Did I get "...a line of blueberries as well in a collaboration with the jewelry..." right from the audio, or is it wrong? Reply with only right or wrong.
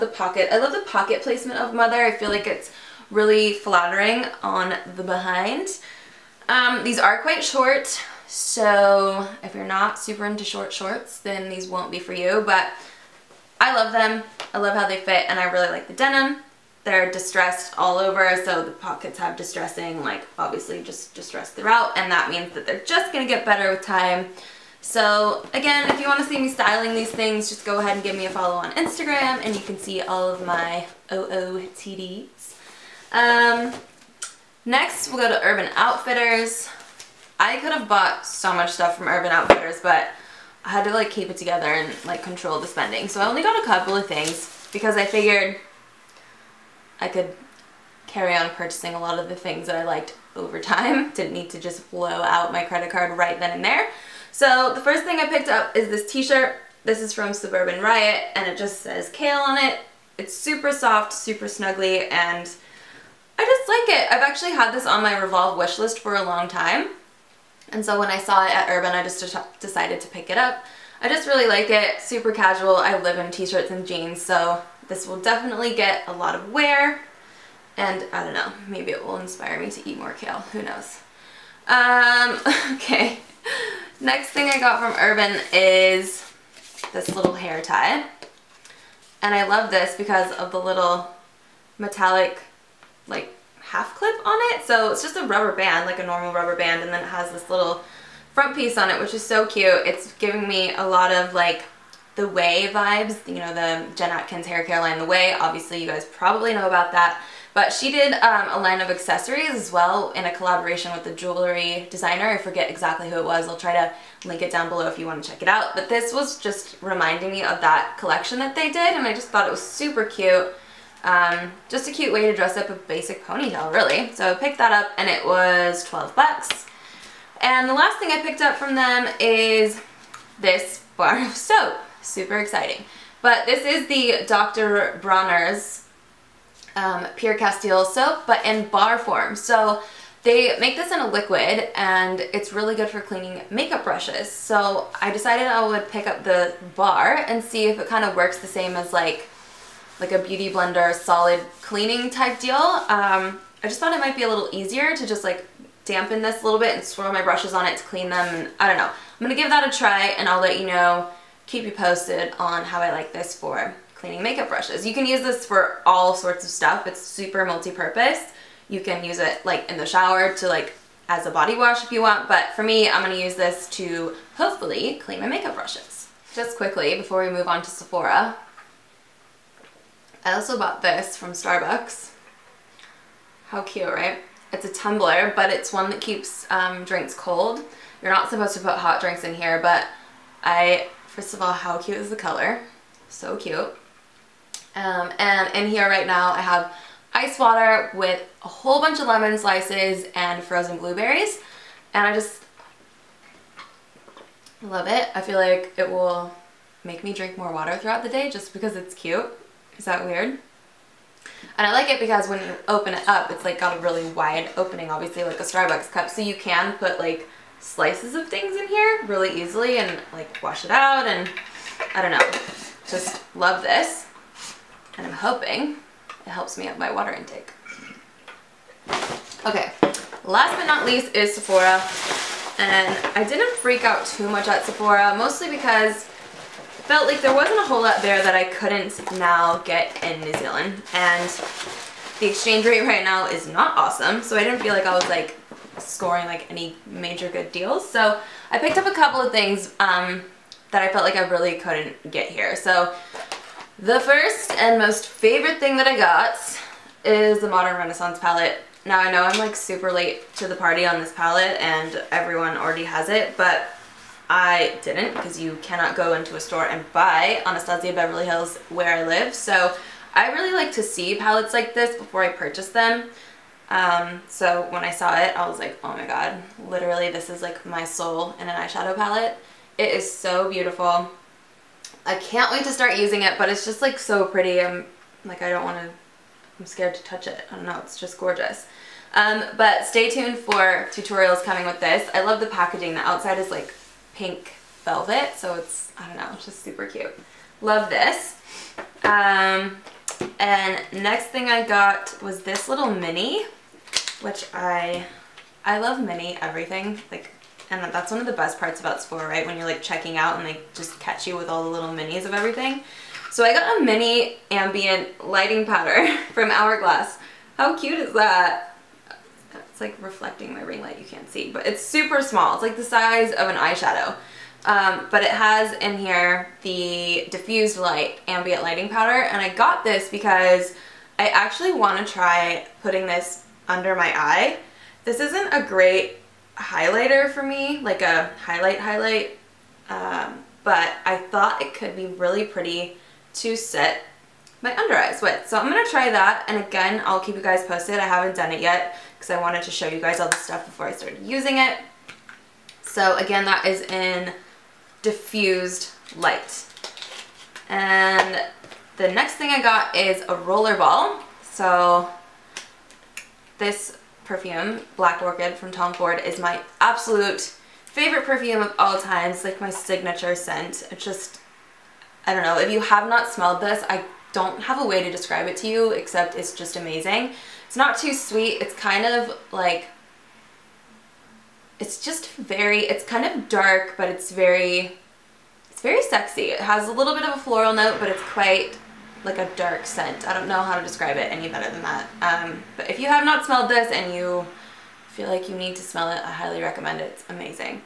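wrong.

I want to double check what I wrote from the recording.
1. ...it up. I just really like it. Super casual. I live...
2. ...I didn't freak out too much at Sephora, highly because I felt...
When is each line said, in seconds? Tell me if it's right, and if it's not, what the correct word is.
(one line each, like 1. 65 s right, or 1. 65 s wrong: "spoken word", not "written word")
1. 70 s right
2. 233 s wrong: "mostly", not "highly".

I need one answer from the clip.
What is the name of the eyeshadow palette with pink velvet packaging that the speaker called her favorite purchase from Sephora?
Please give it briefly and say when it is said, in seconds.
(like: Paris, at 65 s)
Modern Renaissance, at 257 s.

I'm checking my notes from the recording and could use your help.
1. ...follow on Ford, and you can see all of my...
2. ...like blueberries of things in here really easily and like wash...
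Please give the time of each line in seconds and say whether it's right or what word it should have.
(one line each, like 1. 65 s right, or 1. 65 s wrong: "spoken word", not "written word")
1. 28 s wrong: "Instagram", not "Ford"
2. 216 s wrong: "slices", not "blueberries".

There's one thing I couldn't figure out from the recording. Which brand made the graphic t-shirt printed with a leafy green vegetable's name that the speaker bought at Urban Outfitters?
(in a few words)
Suburban Riot.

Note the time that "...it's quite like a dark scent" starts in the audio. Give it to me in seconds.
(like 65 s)
388 s.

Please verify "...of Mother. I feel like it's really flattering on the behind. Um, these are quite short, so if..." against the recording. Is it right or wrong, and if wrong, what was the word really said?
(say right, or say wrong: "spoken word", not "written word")
right.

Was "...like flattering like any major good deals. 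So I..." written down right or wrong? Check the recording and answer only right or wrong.
wrong.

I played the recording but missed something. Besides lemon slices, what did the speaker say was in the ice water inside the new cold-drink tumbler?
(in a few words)
frozen blueberries.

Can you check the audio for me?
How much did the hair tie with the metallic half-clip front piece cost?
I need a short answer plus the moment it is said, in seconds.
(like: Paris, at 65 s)
$12, at 125 s.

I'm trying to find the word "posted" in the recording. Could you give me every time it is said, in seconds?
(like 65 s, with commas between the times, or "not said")
161 s, 347 s.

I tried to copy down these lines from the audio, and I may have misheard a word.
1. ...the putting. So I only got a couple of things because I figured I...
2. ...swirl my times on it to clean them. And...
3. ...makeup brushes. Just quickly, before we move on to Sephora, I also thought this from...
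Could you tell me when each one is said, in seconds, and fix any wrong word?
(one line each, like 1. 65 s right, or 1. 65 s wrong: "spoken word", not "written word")
1. 42 s wrong: "spending", not "putting"
2. 156 s wrong: "brushes", not "times"
3. 175 s wrong: "bought", not "thought".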